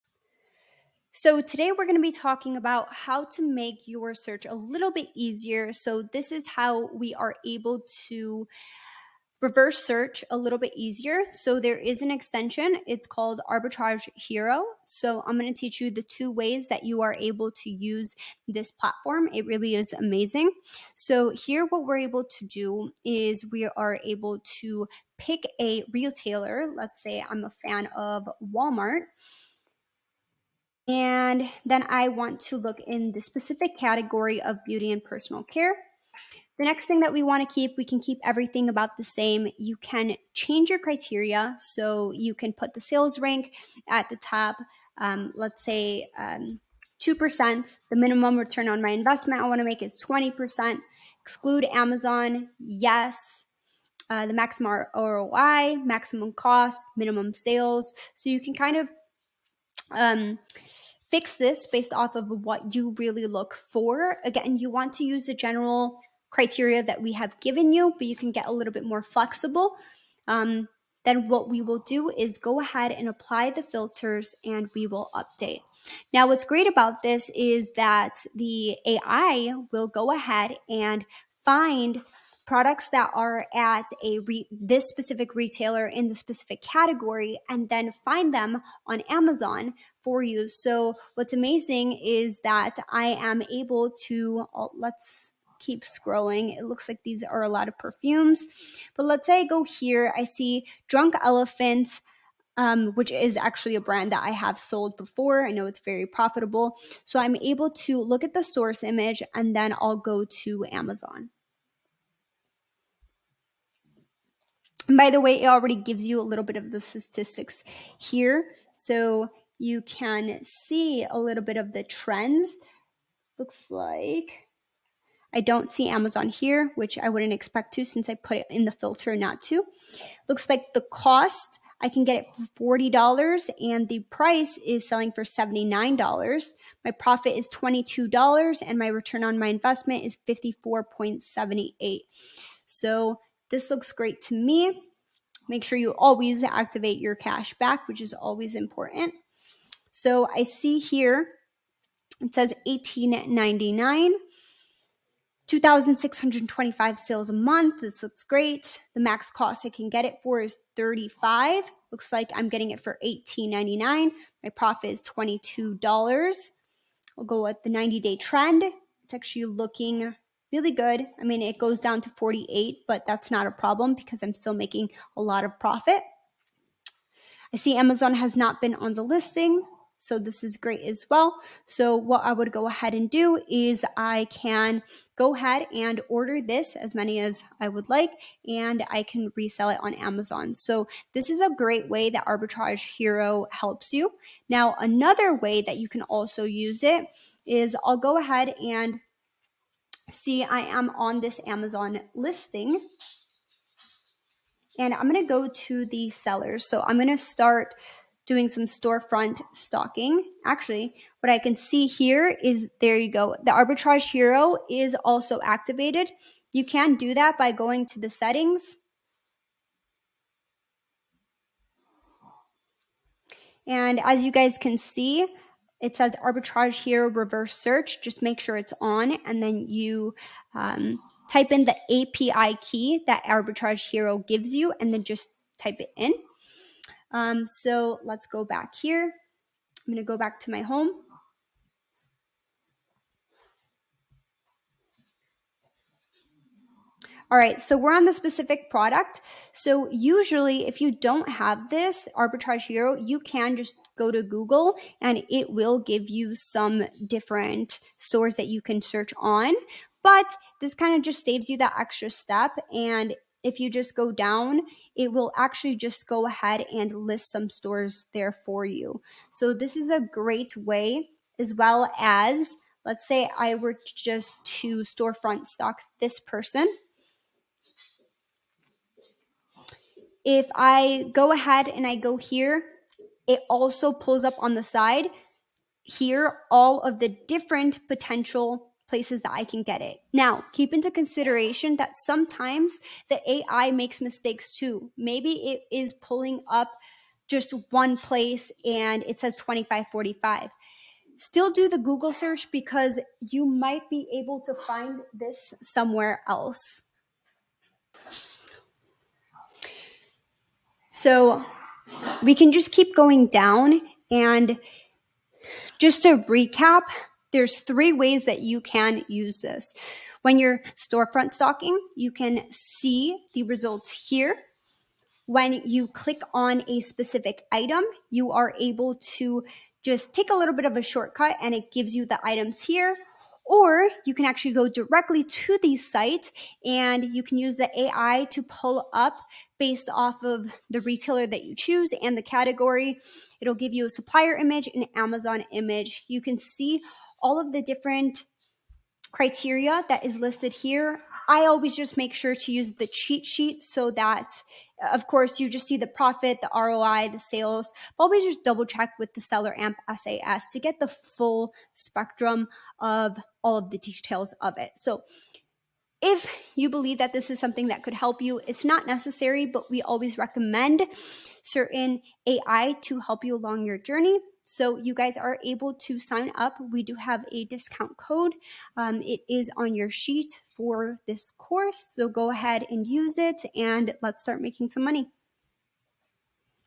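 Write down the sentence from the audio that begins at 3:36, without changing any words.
You can do that by going to the settings.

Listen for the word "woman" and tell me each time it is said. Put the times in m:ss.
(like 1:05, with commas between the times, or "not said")
not said.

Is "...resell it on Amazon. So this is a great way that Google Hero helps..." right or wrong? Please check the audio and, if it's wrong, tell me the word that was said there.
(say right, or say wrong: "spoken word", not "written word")
wrong: "Arbitrage", not "Google".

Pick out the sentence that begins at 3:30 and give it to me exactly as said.
Actually, what I can see here is there you go.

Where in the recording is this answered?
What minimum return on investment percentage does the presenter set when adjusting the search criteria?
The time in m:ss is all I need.
0:50.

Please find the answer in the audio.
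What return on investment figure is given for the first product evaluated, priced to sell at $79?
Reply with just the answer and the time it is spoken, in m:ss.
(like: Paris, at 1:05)
54.78, at 2:20.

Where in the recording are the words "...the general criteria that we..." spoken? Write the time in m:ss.
1:05.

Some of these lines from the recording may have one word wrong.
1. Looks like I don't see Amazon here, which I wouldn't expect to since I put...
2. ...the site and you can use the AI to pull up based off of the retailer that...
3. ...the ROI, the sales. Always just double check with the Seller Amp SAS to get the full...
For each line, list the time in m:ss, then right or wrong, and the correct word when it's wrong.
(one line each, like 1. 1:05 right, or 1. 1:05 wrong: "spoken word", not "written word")
1. 2:03 right
2. 5:35 right
3. 5:56 right.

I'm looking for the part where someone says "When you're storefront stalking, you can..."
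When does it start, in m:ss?
5:20.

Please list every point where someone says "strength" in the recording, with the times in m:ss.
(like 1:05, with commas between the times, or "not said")
not said.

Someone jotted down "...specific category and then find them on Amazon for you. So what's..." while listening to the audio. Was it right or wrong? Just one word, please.
right.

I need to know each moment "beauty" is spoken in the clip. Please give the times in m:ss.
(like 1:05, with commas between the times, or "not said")
0:34.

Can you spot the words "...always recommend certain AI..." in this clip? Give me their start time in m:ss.
6:09.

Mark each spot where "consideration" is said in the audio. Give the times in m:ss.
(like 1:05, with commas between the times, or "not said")
4:50.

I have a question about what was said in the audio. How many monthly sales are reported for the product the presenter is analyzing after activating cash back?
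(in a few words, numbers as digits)
2,625.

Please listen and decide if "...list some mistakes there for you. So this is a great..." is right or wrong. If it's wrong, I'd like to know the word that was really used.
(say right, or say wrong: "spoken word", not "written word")
wrong: "stores", not "mistakes".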